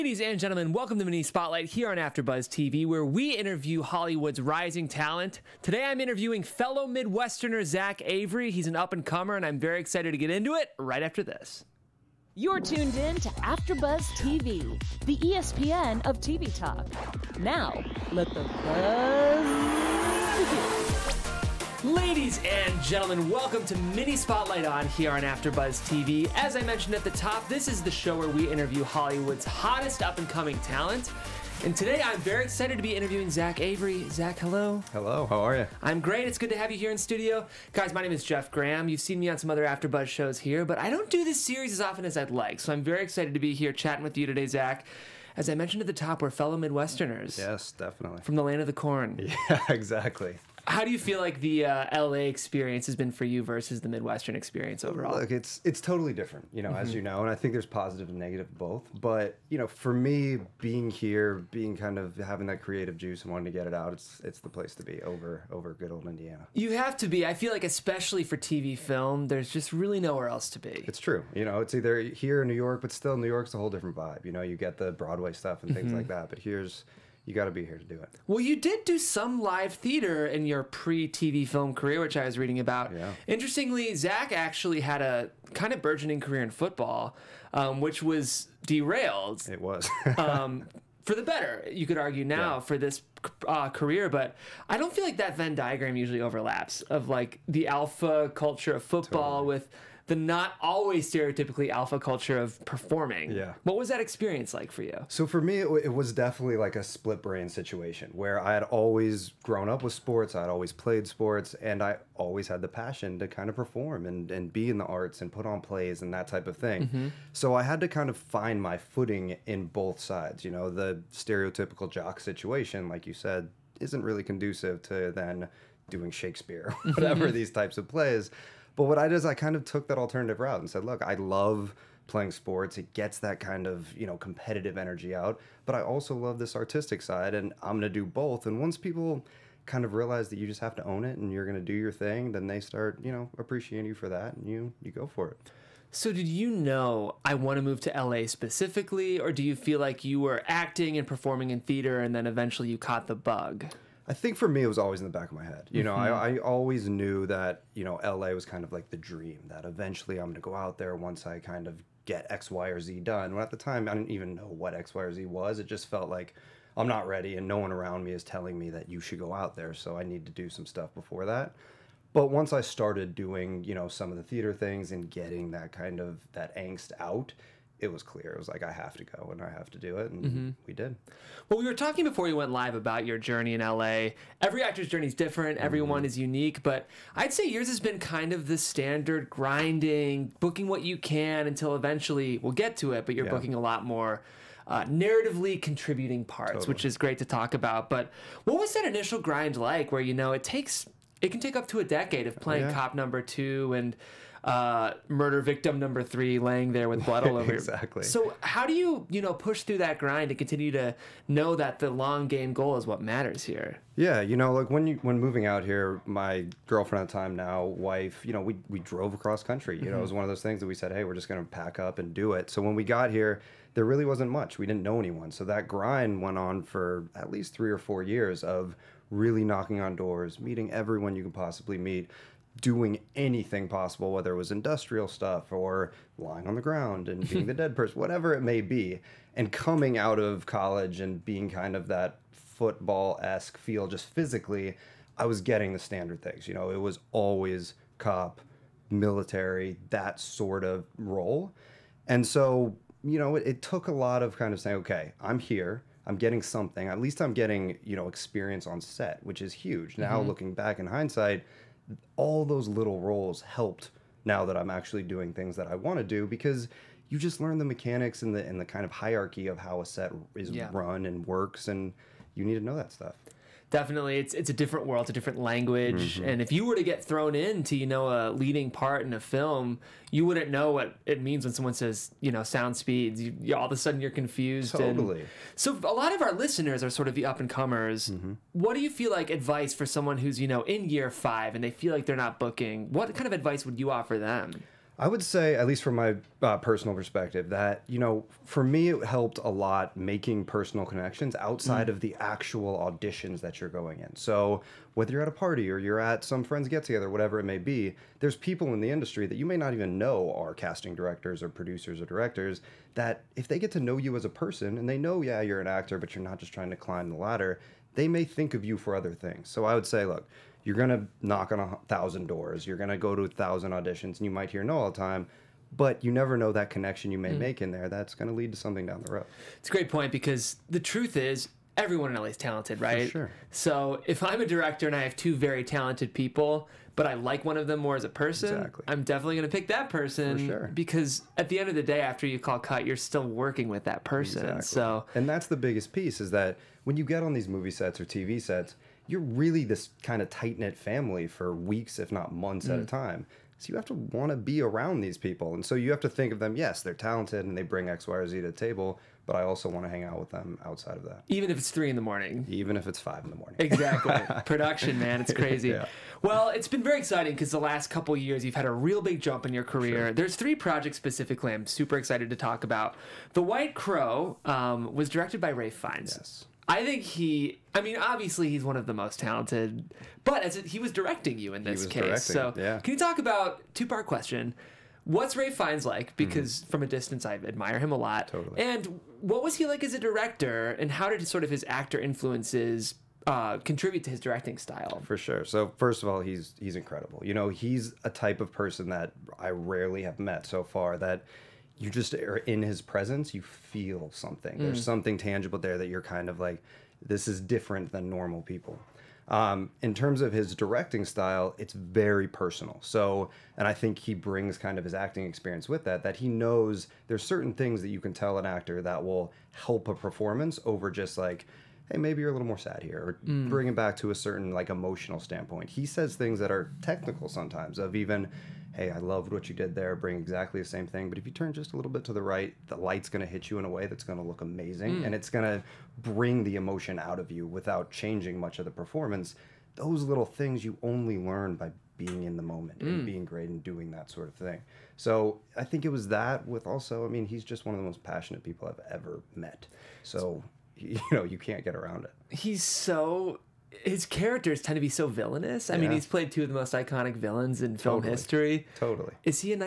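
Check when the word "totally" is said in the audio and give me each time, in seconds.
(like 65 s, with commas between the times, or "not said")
55 s, 99 s, 196 s, 284 s, 388 s, 458 s.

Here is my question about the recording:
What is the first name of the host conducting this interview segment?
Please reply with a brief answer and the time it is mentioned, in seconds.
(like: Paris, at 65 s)
Jeff, at 38 s.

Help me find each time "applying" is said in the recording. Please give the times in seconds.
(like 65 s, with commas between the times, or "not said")
not said.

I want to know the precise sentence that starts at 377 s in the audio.
I mean, obviously he's one of the most talented, but as it, he was directing you in this case, directing, so yeah.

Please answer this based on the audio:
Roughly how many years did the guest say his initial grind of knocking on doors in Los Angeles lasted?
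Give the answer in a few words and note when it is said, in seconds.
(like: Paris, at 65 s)
3 or 4 years, at 227 s.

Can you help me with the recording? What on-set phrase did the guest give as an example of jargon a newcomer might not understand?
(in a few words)
Sound speeds.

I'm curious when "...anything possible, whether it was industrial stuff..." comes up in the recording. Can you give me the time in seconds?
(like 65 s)
233 s.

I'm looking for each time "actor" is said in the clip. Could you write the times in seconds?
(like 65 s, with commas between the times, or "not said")
184 s, 315 s, 391 s, 418 s.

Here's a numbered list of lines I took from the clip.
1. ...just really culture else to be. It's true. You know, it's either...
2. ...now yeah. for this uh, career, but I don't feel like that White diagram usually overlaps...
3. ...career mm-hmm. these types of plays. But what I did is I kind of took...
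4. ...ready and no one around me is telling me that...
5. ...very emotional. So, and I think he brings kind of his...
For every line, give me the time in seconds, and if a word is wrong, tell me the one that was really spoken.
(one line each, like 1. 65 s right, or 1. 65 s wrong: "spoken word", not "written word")
1. 69 s wrong: "nowhere", not "culture"
2. 92 s wrong: "Venn", not "White"
3. 126 s wrong: "whatever", not "career"
4. 167 s right
5. 411 s wrong: "personal", not "emotional".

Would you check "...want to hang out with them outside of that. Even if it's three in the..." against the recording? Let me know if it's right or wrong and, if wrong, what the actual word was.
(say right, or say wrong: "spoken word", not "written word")
right.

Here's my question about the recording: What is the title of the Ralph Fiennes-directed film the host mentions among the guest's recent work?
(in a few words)
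The White Crow.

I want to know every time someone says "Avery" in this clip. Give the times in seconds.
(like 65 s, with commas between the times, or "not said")
8 s, 33 s.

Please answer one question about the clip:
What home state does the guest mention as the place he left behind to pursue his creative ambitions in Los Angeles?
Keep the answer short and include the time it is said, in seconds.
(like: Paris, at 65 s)
Indiana, at 66 s.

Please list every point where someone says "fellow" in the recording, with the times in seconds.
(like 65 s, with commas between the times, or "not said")
6 s, 46 s.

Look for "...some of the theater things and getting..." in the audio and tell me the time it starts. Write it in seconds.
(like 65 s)
173 s.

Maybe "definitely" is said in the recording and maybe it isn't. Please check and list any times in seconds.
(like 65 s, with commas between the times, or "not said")
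47 s, 106 s, 273 s, 339 s.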